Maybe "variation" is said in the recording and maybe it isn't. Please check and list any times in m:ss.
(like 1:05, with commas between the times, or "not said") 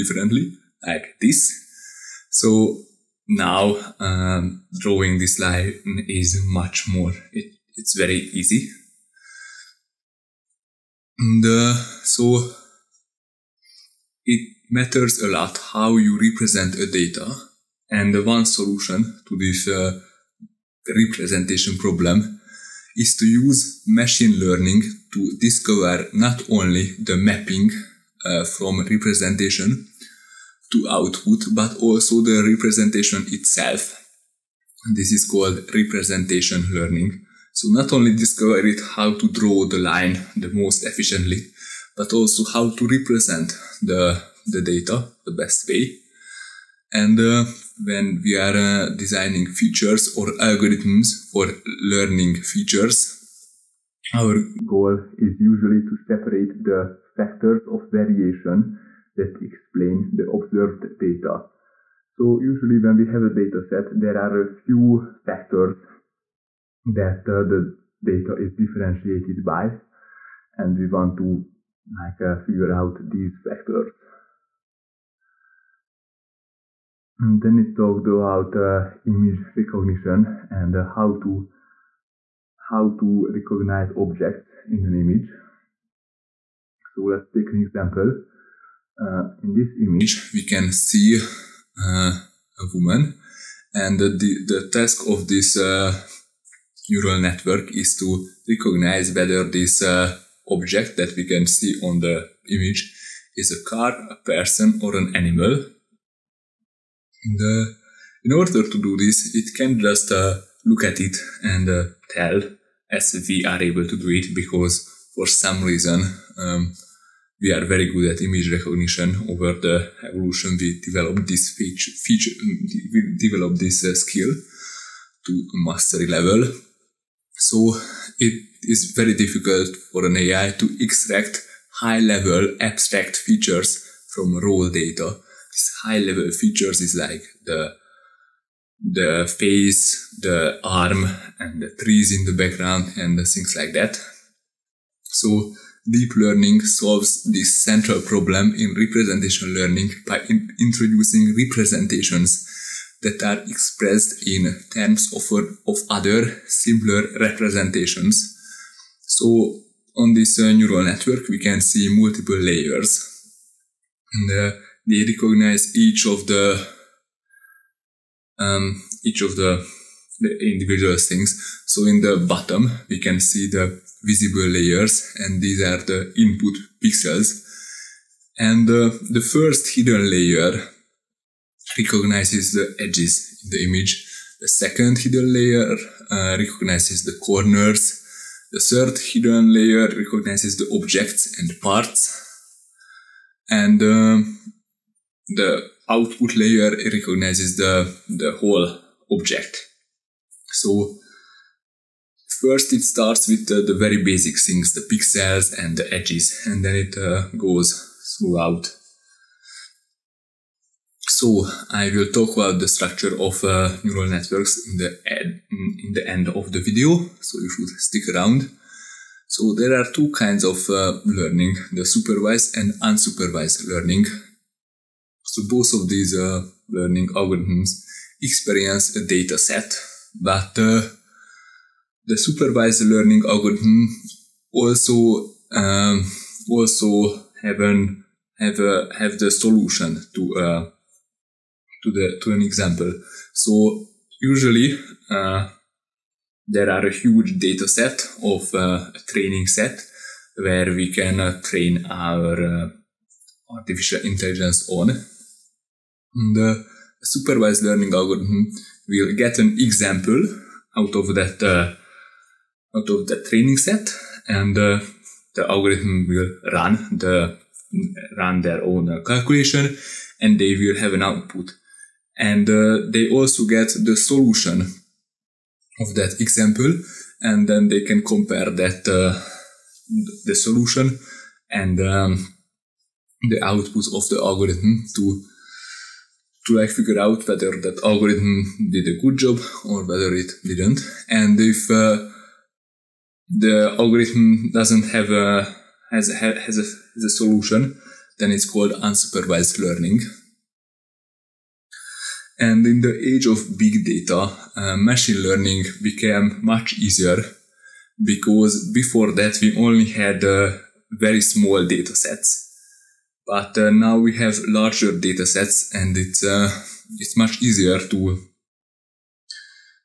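0:57.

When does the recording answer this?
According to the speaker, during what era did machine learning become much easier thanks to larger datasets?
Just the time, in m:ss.
5:03.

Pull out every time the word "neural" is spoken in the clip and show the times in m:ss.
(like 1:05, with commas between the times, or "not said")
1:36, 2:40, 3:33.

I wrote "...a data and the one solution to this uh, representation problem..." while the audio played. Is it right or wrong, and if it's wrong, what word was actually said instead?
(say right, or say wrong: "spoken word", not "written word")
right.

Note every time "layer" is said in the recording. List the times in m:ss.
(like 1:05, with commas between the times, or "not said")
2:42, 2:54, 3:00, 3:05, 3:09, 3:16.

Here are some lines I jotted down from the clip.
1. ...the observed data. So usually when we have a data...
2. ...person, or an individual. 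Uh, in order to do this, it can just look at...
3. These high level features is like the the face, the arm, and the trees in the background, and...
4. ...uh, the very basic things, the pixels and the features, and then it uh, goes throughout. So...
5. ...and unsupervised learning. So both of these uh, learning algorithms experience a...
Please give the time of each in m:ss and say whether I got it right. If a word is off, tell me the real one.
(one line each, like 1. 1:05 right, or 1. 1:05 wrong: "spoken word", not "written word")
1. 1:00 right
2. 1:44 wrong: "animal", not "individual"
3. 2:15 right
4. 3:23 wrong: "edges", not "features"
5. 3:42 right.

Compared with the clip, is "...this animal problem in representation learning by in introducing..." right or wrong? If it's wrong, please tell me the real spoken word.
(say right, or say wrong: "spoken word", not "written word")
wrong: "central", not "animal".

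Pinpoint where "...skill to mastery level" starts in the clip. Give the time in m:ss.
2:03.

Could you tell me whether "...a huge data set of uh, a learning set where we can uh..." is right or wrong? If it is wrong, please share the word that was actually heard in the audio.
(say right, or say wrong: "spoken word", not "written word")
wrong: "training", not "learning".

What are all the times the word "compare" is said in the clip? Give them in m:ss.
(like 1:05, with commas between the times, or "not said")
4:38.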